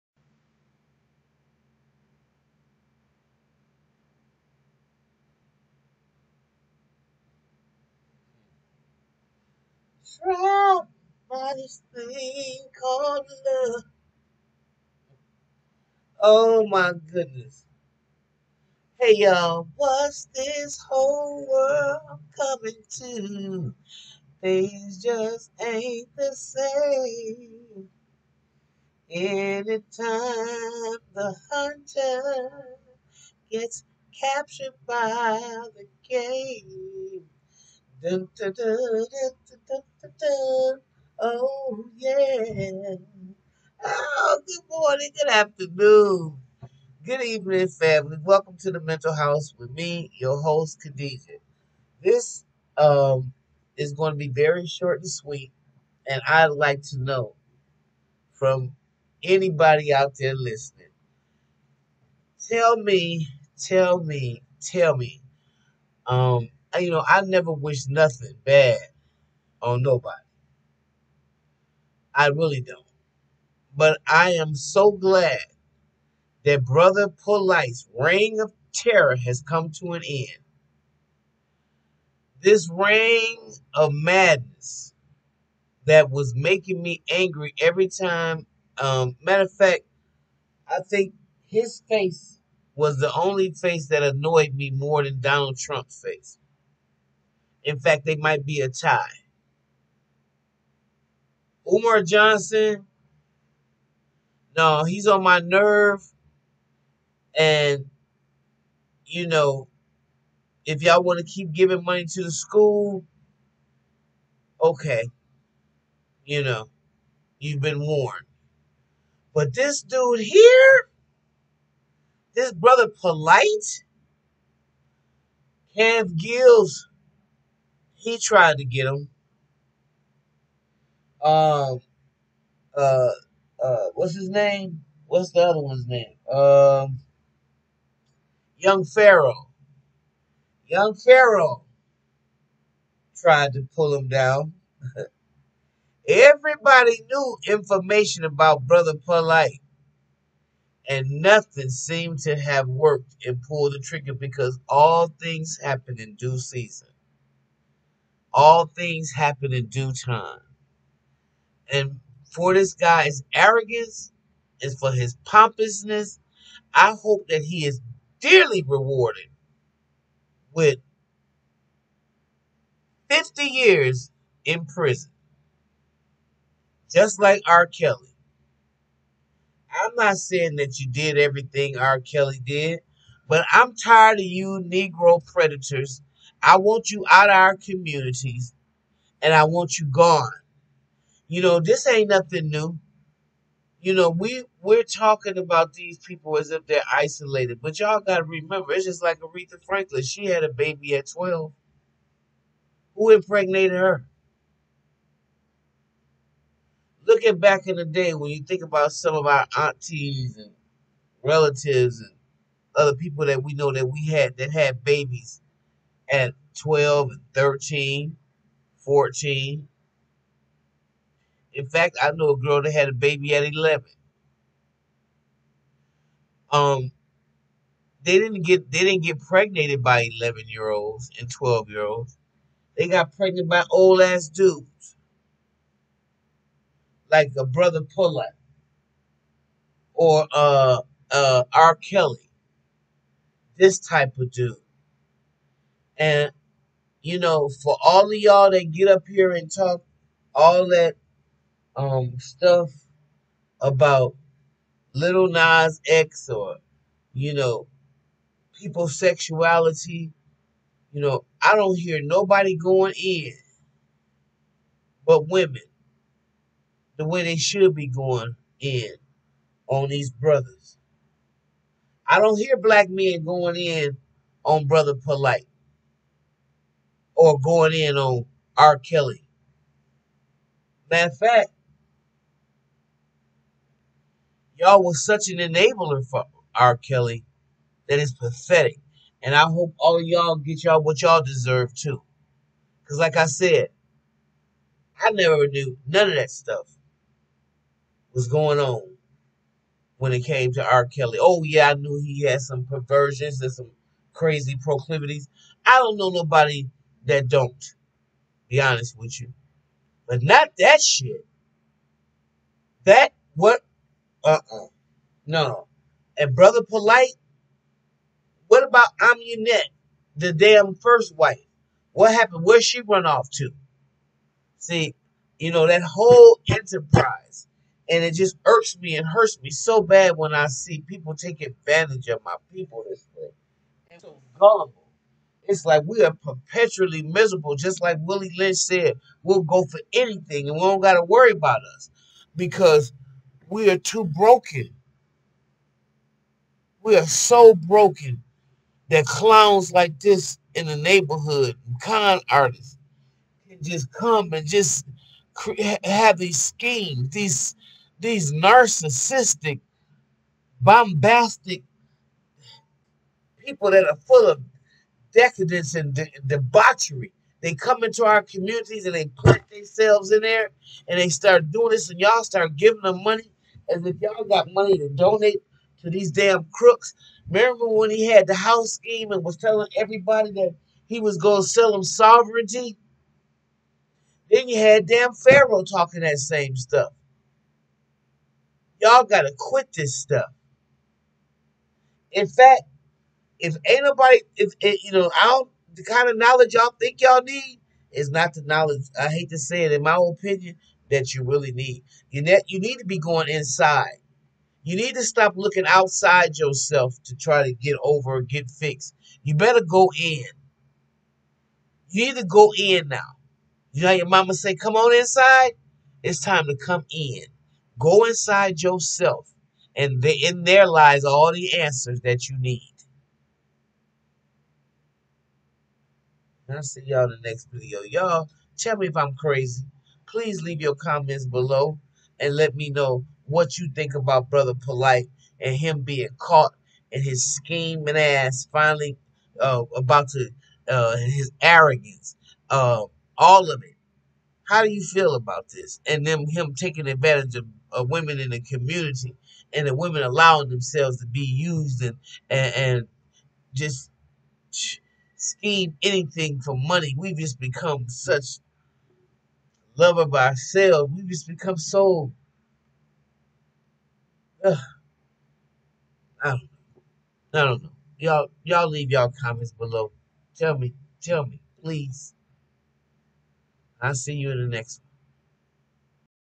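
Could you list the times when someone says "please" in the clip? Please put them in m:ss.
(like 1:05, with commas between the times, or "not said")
7:10, 7:51.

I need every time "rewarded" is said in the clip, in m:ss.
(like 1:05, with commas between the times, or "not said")
2:48.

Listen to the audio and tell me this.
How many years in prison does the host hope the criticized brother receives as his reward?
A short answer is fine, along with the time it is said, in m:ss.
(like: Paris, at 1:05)
50, at 2:53.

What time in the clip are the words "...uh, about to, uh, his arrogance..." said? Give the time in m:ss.
7:19.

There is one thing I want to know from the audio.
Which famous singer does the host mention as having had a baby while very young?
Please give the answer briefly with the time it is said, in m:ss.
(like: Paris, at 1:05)
Aretha Franklin, at 3:19.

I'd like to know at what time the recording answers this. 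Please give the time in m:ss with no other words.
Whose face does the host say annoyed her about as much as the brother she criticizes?
1:35.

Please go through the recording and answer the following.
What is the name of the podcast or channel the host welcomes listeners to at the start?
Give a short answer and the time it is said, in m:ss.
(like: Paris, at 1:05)
The Mental House, at 0:48.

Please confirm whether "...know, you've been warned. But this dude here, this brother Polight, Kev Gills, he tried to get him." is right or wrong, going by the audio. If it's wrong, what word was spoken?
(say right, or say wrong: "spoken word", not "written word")
right.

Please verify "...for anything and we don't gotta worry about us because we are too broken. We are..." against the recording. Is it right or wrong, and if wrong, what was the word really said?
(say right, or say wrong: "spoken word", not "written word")
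right.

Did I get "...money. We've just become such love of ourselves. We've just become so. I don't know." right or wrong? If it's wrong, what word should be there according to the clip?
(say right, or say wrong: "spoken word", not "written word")
right.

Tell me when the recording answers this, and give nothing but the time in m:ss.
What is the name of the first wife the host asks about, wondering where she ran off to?
5:18.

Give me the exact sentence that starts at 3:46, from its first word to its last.
Um, they didn't get they didn't get pregnant by 11 year olds and 12 year olds.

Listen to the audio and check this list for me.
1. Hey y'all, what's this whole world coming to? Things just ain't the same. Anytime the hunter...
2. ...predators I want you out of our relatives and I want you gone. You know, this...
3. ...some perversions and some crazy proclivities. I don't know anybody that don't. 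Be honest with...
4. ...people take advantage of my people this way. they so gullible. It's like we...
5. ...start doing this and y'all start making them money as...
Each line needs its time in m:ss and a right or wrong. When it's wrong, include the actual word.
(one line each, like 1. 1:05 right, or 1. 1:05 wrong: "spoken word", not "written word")
1. 0:18 right
2. 3:05 wrong: "communities", not "relatives"
3. 5:02 wrong: "nobody", not "anybody"
4. 5:30 right
5. 6:11 wrong: "giving", not "making".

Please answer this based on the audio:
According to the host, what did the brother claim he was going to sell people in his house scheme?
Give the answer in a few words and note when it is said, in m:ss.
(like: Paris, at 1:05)
Sovereignty, at 6:21.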